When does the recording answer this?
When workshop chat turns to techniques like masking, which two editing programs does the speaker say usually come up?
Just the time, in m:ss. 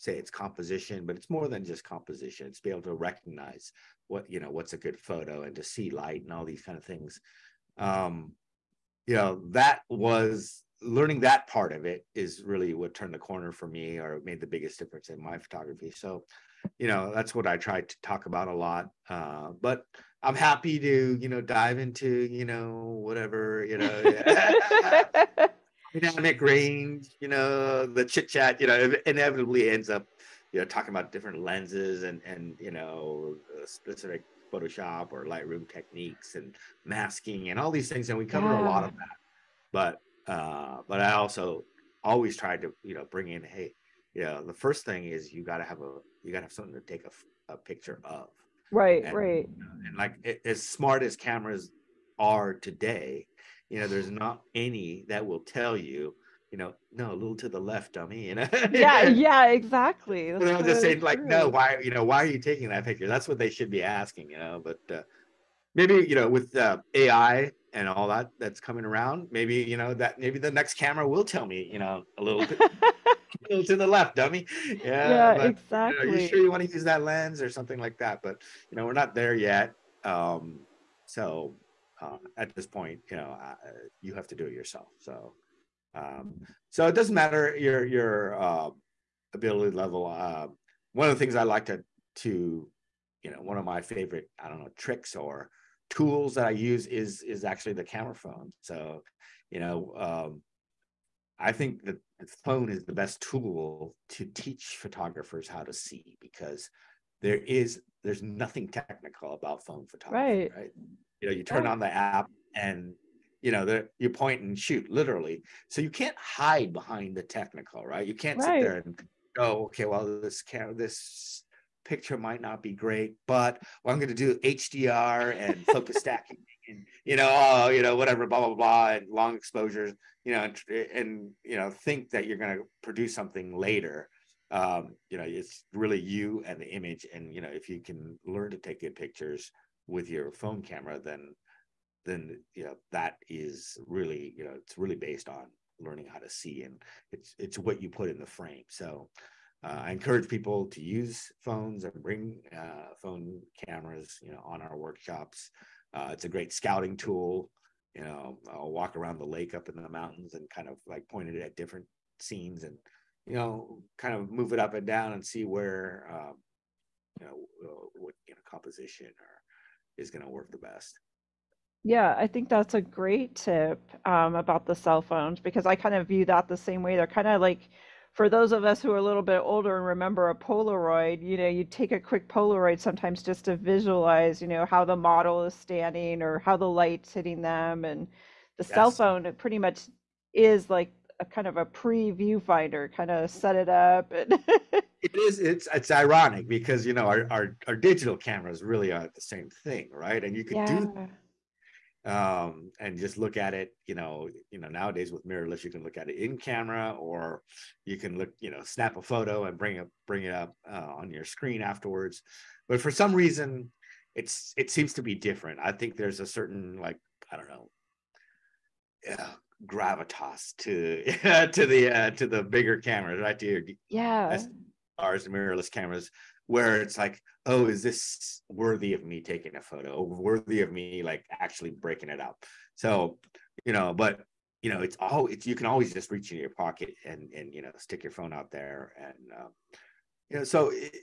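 0:34.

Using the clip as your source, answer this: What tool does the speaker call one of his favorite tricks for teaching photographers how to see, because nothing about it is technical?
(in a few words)
camera phone.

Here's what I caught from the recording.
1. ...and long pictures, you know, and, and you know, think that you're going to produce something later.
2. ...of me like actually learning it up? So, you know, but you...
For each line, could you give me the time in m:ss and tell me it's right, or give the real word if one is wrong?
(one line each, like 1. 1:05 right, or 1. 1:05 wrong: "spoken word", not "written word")
1. 2:08 wrong: "exposures", not "pictures"
2. 3:50 wrong: "breaking", not "learning".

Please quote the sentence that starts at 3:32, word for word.
But for some reason, it's it seems to be different.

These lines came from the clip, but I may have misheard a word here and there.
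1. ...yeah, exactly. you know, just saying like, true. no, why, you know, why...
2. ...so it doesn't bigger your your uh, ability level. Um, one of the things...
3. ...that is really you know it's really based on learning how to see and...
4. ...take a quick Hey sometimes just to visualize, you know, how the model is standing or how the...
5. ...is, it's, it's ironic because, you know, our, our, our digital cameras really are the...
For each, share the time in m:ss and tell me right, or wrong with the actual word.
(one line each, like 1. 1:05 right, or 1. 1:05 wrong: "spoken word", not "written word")
1. 0:59 right
2. 1:26 wrong: "matter", not "bigger"
3. 2:22 right
4. 3:01 wrong: "Polaroid", not "Hey"
5. 3:15 right.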